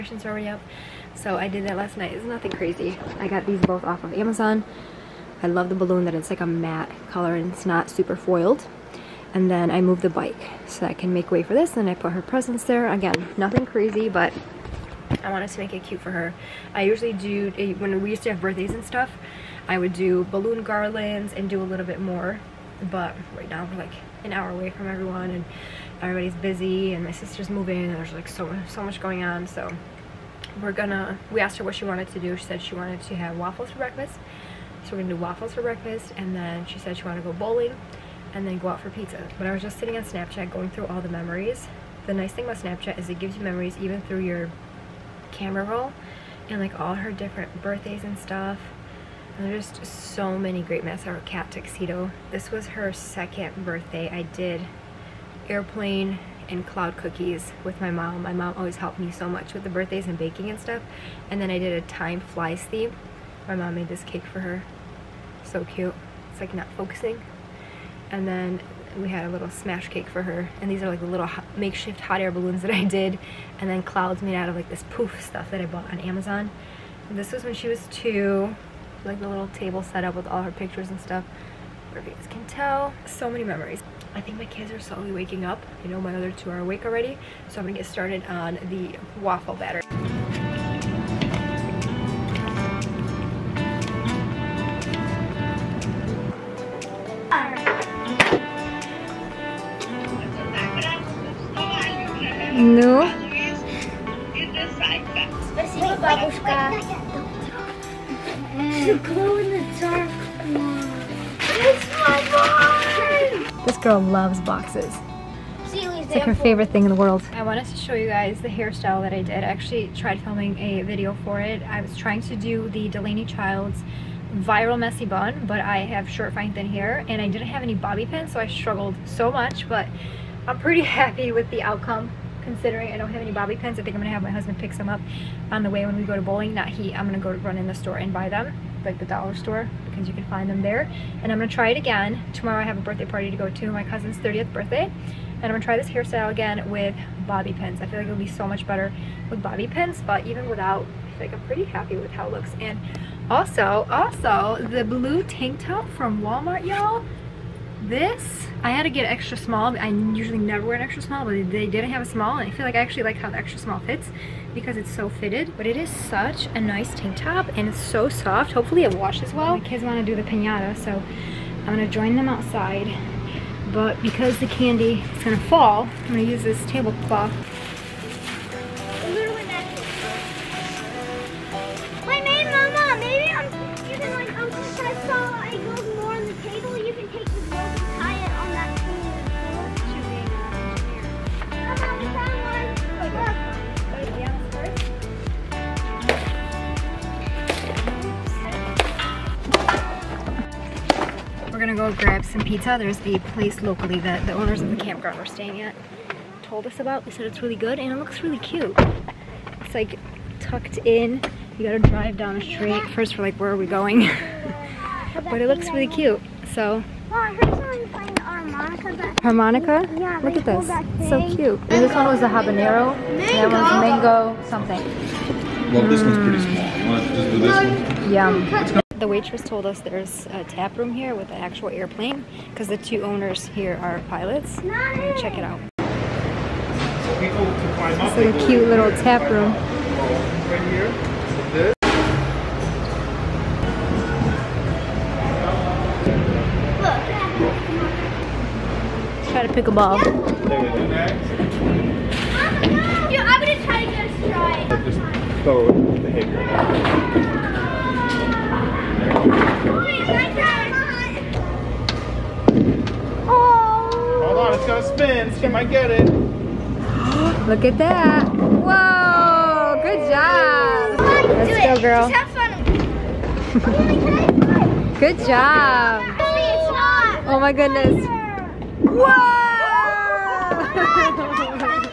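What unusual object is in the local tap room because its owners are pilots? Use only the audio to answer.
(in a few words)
An actual airplane.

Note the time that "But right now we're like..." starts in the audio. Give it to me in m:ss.
0:22.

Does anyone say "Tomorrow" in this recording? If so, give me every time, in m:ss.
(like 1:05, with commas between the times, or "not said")
2:22.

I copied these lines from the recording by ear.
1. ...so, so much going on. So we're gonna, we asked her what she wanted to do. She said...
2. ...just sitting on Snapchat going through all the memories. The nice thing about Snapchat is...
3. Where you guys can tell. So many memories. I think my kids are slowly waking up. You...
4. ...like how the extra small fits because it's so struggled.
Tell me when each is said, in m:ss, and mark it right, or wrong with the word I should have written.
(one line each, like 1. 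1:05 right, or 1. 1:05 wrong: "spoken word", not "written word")
1. 0:28 right
2. 0:39 right
3. 1:21 right
4. 2:43 wrong: "fitted", not "struggled".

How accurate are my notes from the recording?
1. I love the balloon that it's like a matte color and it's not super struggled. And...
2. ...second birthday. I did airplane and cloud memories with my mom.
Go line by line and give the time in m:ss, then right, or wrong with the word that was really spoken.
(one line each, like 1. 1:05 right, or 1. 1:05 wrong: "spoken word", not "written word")
1. 0:05 wrong: "foiled", not "struggled"
2. 0:52 wrong: "cookies", not "memories".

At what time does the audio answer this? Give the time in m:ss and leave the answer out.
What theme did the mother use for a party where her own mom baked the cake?
1:01.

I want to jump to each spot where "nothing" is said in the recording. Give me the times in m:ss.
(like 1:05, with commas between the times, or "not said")
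0:02, 0:13.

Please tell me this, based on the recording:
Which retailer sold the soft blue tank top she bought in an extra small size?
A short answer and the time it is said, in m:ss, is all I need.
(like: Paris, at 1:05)
Walmart, at 2:36.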